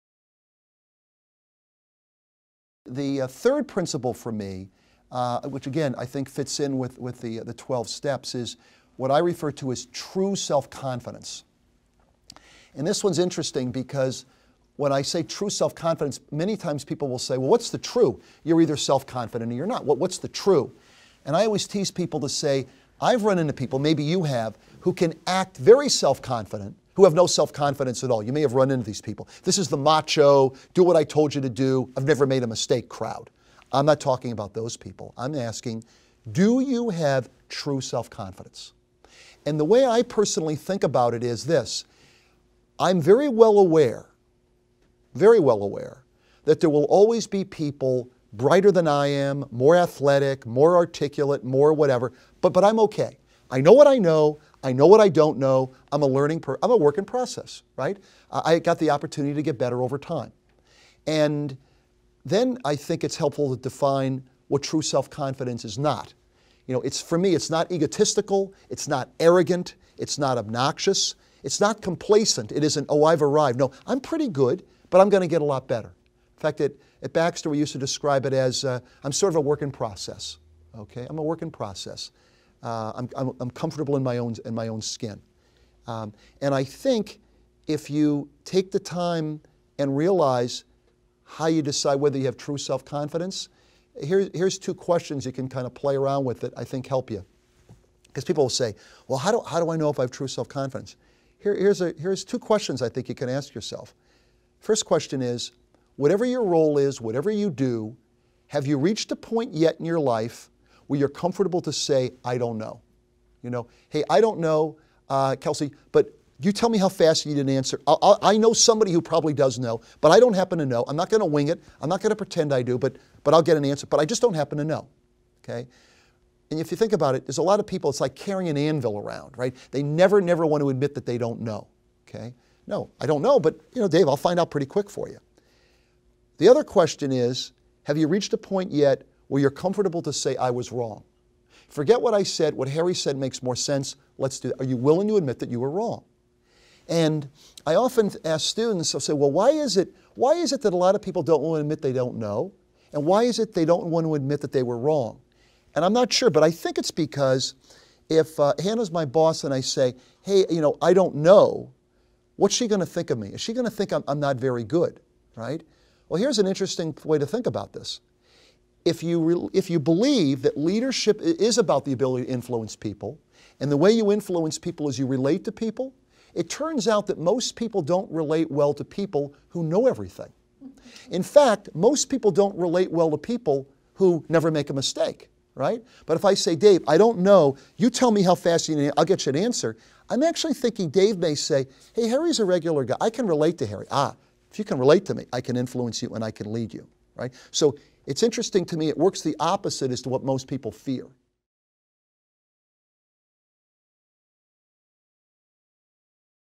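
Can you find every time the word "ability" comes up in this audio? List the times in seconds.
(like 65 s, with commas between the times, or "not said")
171 s.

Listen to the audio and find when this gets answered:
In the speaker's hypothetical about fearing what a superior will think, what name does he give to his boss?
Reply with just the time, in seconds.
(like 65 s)
158 s.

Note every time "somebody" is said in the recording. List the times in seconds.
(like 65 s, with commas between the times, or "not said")
118 s.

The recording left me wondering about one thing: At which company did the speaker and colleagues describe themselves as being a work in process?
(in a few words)
Baxter.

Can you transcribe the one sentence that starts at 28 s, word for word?
You may have run into these people.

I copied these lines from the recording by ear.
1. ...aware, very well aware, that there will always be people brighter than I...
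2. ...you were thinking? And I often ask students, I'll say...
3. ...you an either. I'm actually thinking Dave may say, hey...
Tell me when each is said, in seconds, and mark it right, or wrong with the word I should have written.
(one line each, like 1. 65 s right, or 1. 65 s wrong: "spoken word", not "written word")
1. 43 s right
2. 145 s wrong: "wrong", not "thinking"
3. 189 s wrong: "answer", not "either".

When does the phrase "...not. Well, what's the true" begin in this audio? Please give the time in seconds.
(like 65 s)
19 s.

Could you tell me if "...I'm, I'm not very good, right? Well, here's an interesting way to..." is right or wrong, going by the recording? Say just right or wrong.
right.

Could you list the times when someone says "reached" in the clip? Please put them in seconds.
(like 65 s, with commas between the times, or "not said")
108 s, 138 s.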